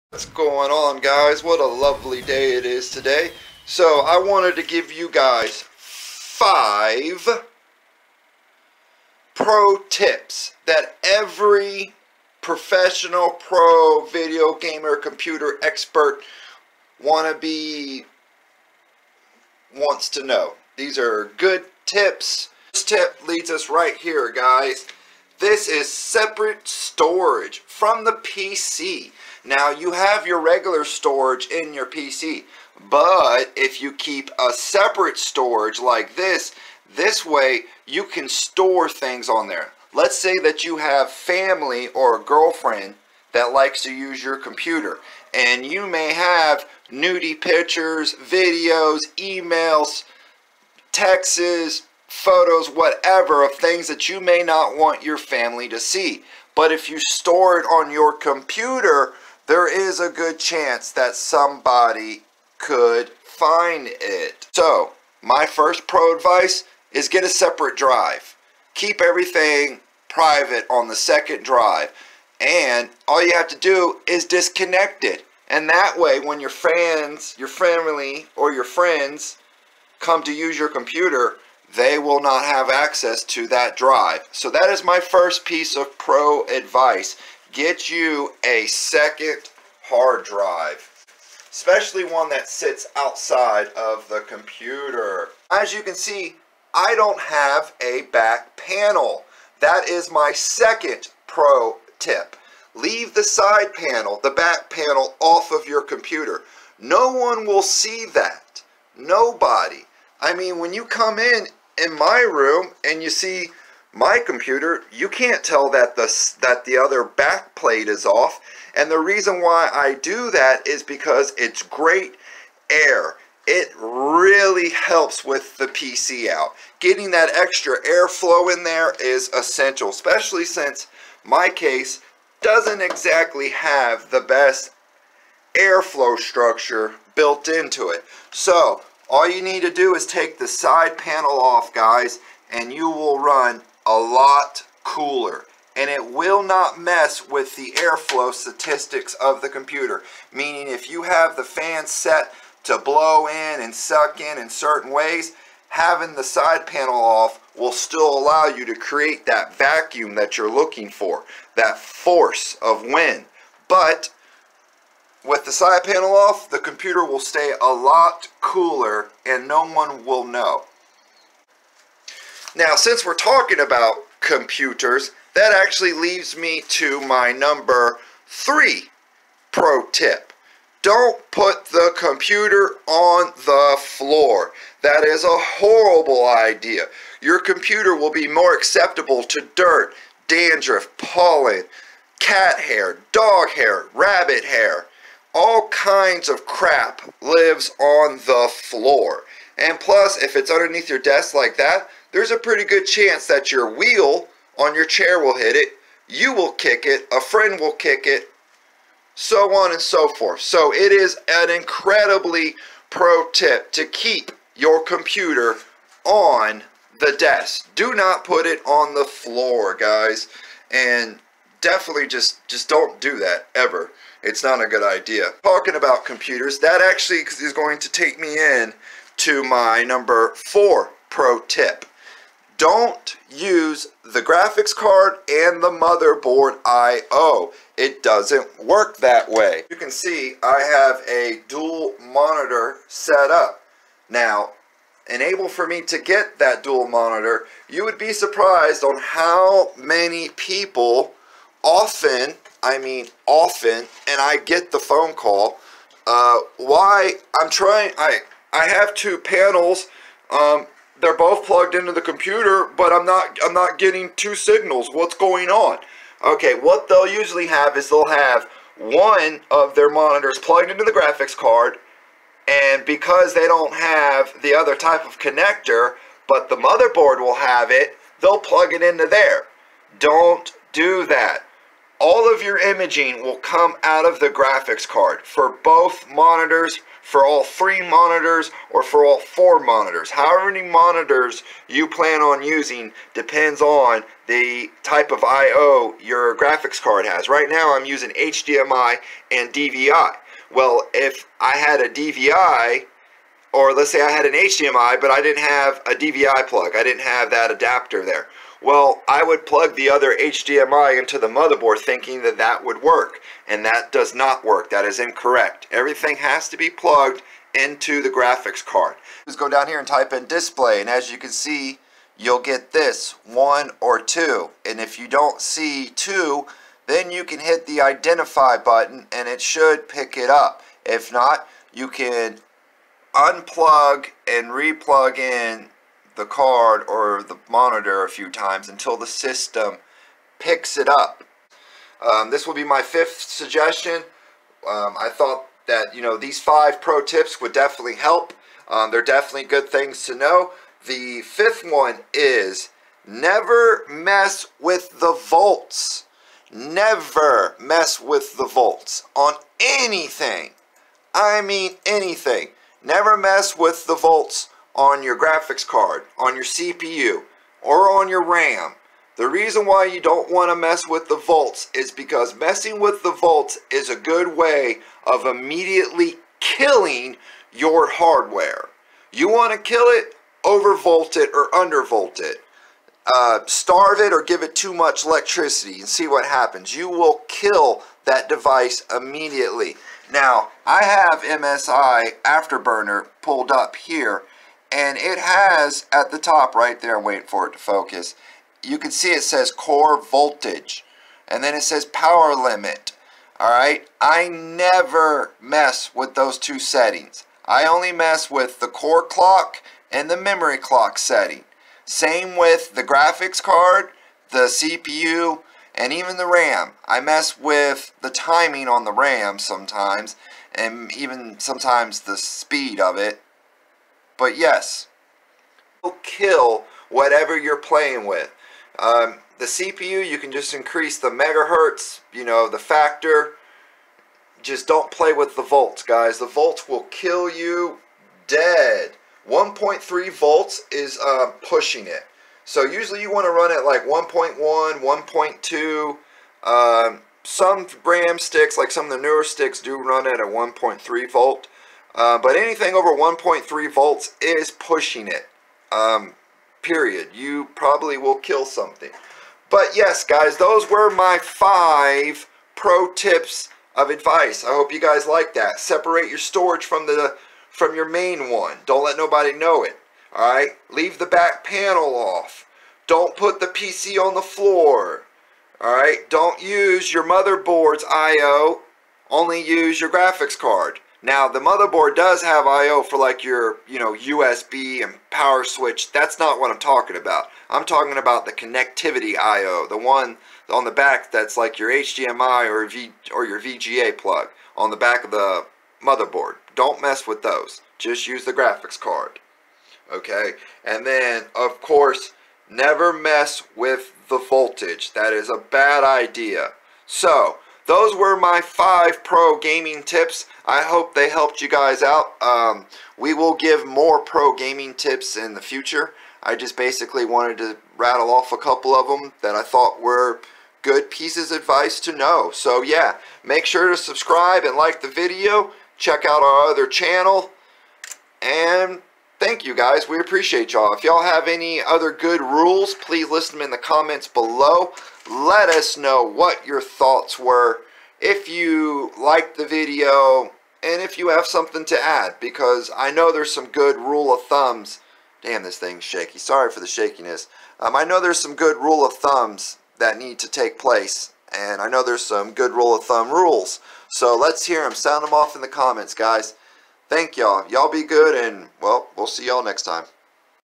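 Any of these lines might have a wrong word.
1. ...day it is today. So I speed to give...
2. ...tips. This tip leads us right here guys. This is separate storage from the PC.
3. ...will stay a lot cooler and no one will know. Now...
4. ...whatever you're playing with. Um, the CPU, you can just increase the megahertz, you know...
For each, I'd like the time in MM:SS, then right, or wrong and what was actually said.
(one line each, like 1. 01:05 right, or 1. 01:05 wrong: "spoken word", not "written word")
1. 00:02 wrong: "wanted", not "speed"
2. 00:21 right
3. 02:47 right
4. 07:06 right.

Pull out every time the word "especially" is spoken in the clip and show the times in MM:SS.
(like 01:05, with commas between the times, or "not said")
01:31, 02:09.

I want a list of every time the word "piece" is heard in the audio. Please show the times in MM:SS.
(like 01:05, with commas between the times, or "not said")
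01:25, 08:40.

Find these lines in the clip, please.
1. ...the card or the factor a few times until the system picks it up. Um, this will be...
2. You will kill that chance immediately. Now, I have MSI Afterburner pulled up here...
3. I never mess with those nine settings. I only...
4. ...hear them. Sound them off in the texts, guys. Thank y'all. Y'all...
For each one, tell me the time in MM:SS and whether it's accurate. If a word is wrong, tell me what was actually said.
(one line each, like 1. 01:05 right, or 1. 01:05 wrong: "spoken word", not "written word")
1. 05:36 wrong: "monitor", not "factor"
2. 06:26 wrong: "device", not "chance"
3. 06:43 wrong: "two", not "nine"
4. 09:14 wrong: "comments", not "texts".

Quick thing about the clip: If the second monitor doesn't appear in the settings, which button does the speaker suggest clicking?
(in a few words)
identify.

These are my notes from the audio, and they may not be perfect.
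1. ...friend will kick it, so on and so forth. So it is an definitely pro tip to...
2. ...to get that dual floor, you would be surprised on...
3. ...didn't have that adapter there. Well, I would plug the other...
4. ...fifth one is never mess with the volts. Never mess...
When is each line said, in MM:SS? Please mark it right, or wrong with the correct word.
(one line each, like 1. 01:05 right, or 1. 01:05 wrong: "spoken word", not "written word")
1. 03:27 wrong: "incredibly", not "definitely"
2. 04:05 wrong: "monitor", not "floor"
3. 05:06 right
4. 05:51 right.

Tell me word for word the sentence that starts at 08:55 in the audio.
Let us know what your thoughts were.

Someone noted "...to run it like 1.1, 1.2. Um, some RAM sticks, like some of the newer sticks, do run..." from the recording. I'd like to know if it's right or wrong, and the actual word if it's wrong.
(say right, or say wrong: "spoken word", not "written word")
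right.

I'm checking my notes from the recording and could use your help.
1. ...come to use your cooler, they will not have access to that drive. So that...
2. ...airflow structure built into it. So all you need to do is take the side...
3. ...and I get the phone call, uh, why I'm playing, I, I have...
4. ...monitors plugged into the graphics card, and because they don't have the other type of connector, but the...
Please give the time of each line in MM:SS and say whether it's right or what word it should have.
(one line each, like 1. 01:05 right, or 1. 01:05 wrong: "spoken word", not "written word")
1. 01:19 wrong: "computer", not "cooler"
2. 02:15 right
3. 04:14 wrong: "trying", not "playing"
4. 04:29 right.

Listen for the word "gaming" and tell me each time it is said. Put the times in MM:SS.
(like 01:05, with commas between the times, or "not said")
08:29, 08:34.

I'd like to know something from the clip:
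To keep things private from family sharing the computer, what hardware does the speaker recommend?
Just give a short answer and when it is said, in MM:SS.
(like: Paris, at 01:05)
separate drive, at 01:07.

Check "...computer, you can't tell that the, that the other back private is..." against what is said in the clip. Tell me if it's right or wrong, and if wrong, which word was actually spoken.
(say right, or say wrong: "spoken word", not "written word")
wrong: "plate", not "private".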